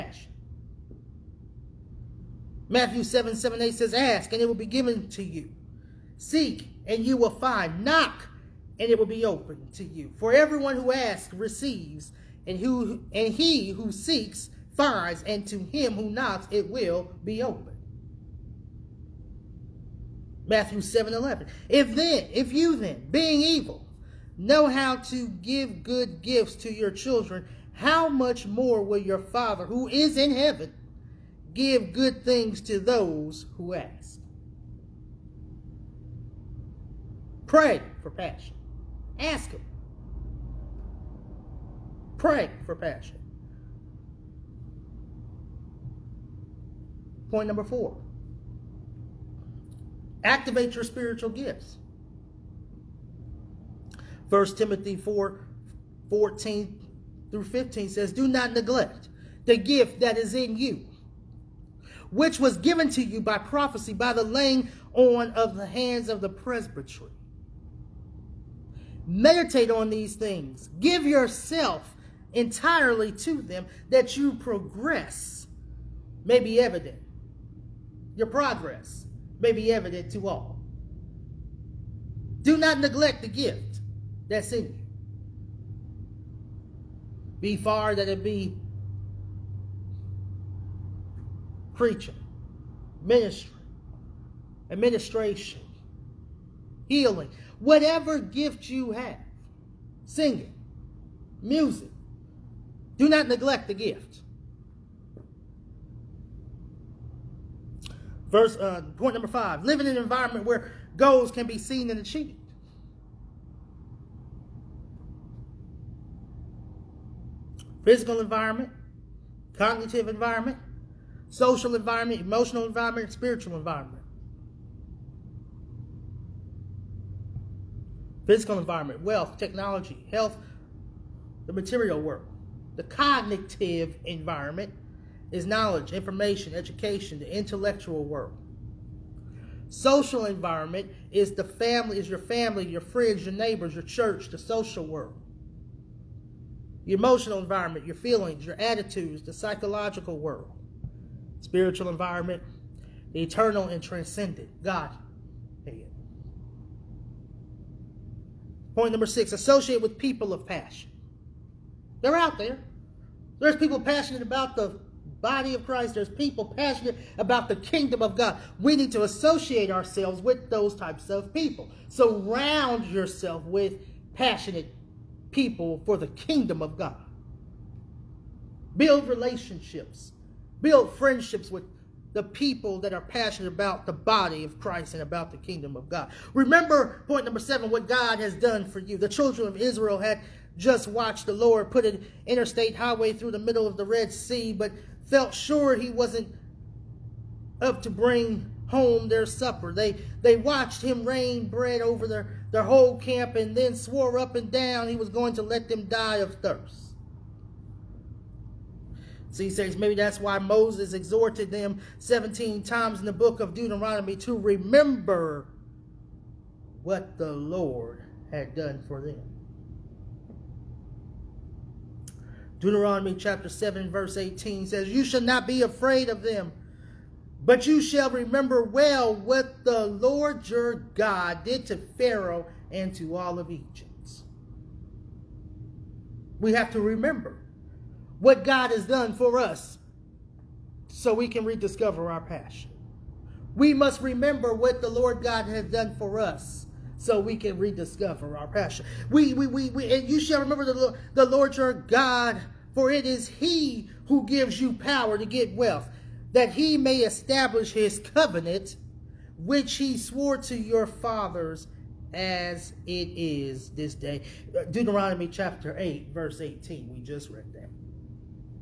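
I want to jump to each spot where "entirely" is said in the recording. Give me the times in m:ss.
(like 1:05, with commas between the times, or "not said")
1:12.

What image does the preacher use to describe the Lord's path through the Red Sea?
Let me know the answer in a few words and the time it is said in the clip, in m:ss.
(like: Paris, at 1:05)
An interstate highway, at 3:12.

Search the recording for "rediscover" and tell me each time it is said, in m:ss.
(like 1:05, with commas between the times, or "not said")
4:01, 4:07.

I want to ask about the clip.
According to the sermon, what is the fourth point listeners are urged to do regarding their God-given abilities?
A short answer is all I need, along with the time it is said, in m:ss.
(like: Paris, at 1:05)
Activate your spiritual gifts, at 0:50.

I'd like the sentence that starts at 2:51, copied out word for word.
Surround yourself with passionate people for the kingdom of God.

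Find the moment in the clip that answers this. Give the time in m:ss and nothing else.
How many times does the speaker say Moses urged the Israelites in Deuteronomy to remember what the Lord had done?
3:31.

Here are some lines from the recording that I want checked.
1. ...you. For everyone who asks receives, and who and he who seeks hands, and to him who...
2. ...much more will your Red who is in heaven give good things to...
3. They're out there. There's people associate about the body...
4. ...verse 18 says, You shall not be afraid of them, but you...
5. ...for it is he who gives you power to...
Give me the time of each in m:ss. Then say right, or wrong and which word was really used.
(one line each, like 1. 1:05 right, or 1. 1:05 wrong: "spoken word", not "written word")
1. 0:09 wrong: "finds", not "hands"
2. 0:28 wrong: "Father", not "Red"
3. 2:42 wrong: "passionate", not "associate"
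4. 3:43 right
5. 4:12 right.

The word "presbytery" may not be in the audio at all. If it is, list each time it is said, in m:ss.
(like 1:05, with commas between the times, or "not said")
1:06.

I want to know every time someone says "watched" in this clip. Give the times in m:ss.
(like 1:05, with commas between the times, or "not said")
3:10, 3:20.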